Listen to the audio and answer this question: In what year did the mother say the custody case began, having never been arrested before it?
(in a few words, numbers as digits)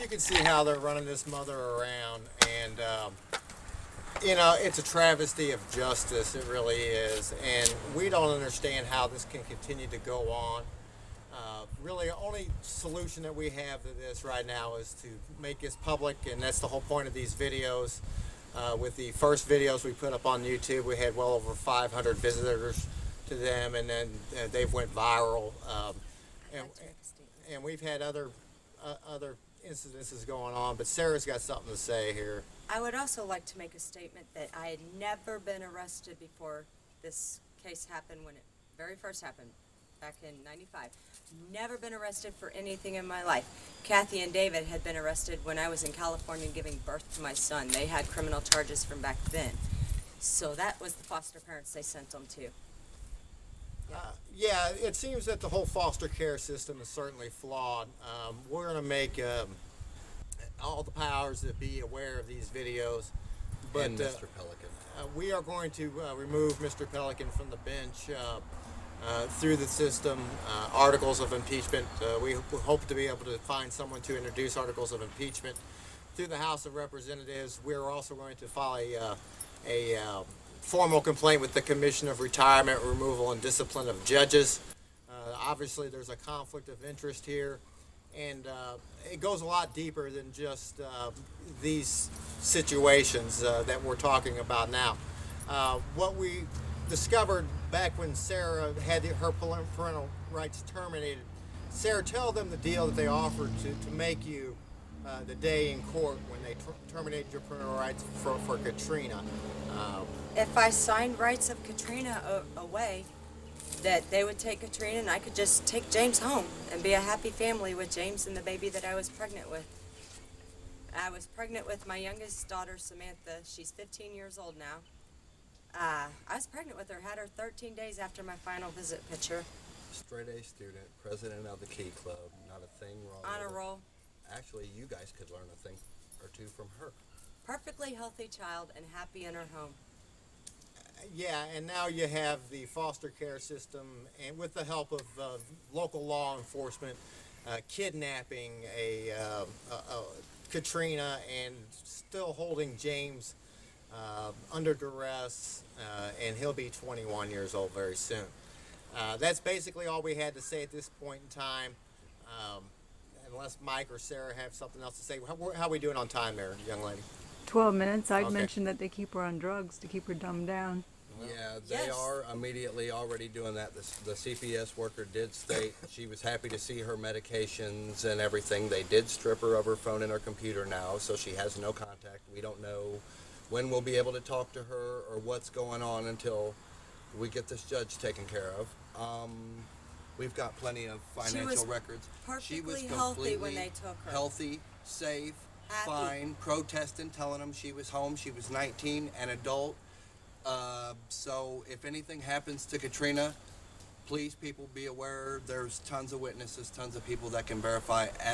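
1995.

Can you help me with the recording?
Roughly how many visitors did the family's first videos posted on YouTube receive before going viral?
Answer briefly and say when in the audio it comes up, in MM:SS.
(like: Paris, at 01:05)
500, at 00:21.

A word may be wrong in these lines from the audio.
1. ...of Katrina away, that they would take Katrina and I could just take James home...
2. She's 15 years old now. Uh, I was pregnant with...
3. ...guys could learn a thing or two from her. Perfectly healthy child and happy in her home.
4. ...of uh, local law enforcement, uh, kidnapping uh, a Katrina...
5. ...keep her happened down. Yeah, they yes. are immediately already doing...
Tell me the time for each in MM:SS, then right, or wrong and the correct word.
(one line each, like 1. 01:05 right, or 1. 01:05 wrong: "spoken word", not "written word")
1. 01:51 right
2. 02:03 right
3. 02:14 right
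4. 02:24 right
5. 02:49 wrong: "dumbed", not "happened".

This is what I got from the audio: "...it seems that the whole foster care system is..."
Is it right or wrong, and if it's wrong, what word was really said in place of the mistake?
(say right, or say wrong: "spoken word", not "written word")
right.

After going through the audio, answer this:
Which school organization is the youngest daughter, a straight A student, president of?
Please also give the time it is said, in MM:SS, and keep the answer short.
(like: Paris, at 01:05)
Key Club, at 02:11.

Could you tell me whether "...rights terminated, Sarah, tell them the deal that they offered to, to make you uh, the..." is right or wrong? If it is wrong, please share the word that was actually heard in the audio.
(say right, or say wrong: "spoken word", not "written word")
right.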